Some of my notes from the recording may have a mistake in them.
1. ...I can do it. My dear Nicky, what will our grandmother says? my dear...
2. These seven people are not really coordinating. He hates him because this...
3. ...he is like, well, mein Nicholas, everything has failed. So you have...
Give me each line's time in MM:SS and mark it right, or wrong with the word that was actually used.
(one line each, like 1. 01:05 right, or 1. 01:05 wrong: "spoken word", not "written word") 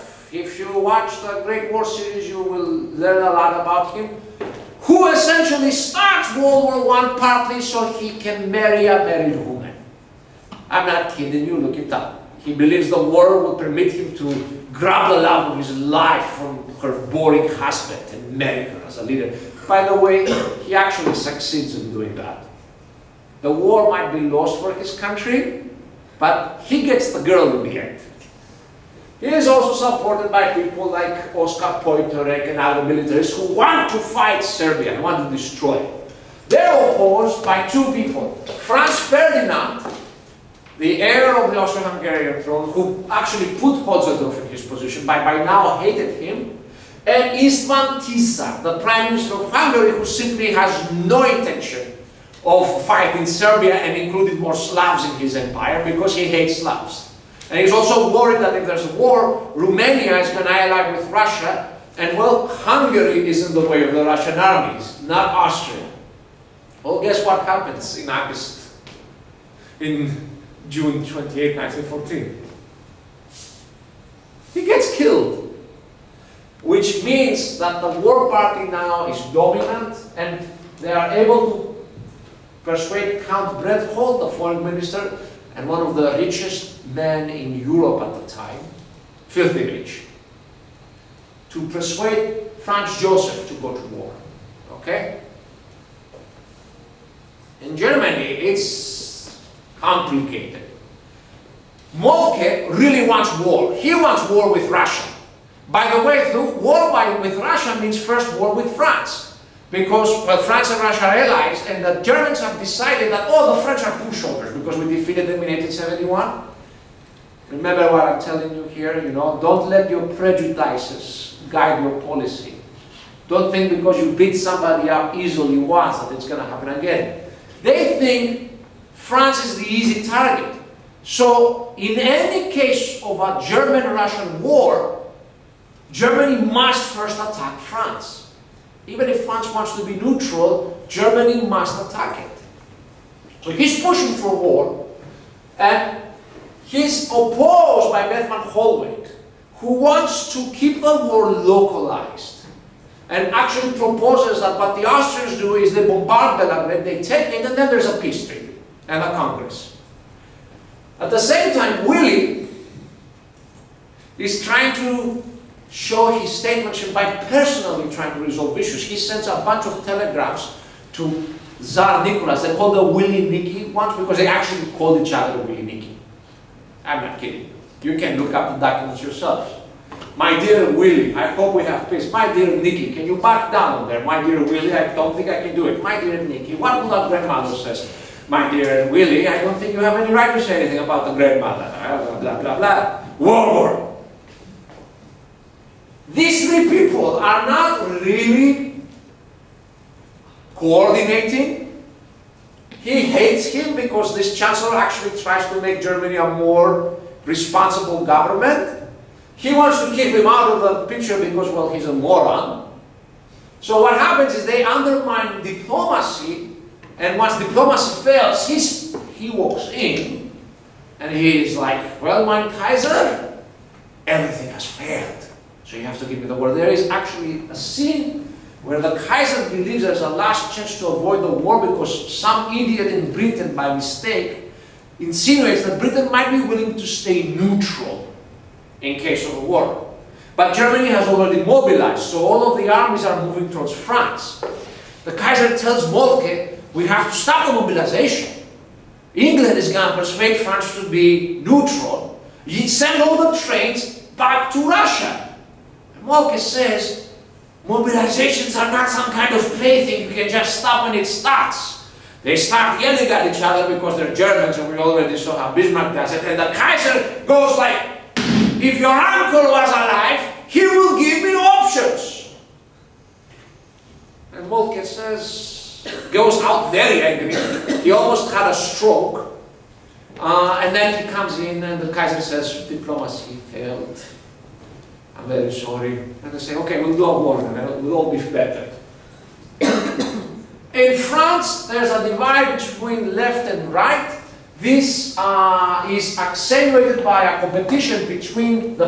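1. 03:05 right
2. 03:16 wrong: "three", not "seven"
3. 03:41 wrong: "Kaiser", not "Nicholas".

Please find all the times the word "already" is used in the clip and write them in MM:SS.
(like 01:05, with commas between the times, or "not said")
04:01, 04:24.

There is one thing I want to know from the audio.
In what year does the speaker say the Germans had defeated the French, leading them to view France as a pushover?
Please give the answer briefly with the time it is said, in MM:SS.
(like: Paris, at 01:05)
1871, at 01:55.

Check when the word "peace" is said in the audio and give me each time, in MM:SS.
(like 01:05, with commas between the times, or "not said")
02:37, 03:01.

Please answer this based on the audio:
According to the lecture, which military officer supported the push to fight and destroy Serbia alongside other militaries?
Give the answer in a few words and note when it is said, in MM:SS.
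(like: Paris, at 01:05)
Oskar Potiorek, at 00:31.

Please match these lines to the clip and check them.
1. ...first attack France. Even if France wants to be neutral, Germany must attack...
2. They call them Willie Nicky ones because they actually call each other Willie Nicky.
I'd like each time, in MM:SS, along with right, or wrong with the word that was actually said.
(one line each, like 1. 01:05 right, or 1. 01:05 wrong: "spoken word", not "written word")
1. 02:16 right
2. 02:52 right.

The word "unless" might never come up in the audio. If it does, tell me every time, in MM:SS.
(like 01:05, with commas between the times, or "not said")
not said.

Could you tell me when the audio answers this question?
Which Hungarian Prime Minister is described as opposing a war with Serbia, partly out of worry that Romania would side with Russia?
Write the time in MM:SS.
00:47.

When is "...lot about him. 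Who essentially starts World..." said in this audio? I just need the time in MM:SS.
00:03.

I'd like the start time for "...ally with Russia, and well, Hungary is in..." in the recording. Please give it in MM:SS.
01:00.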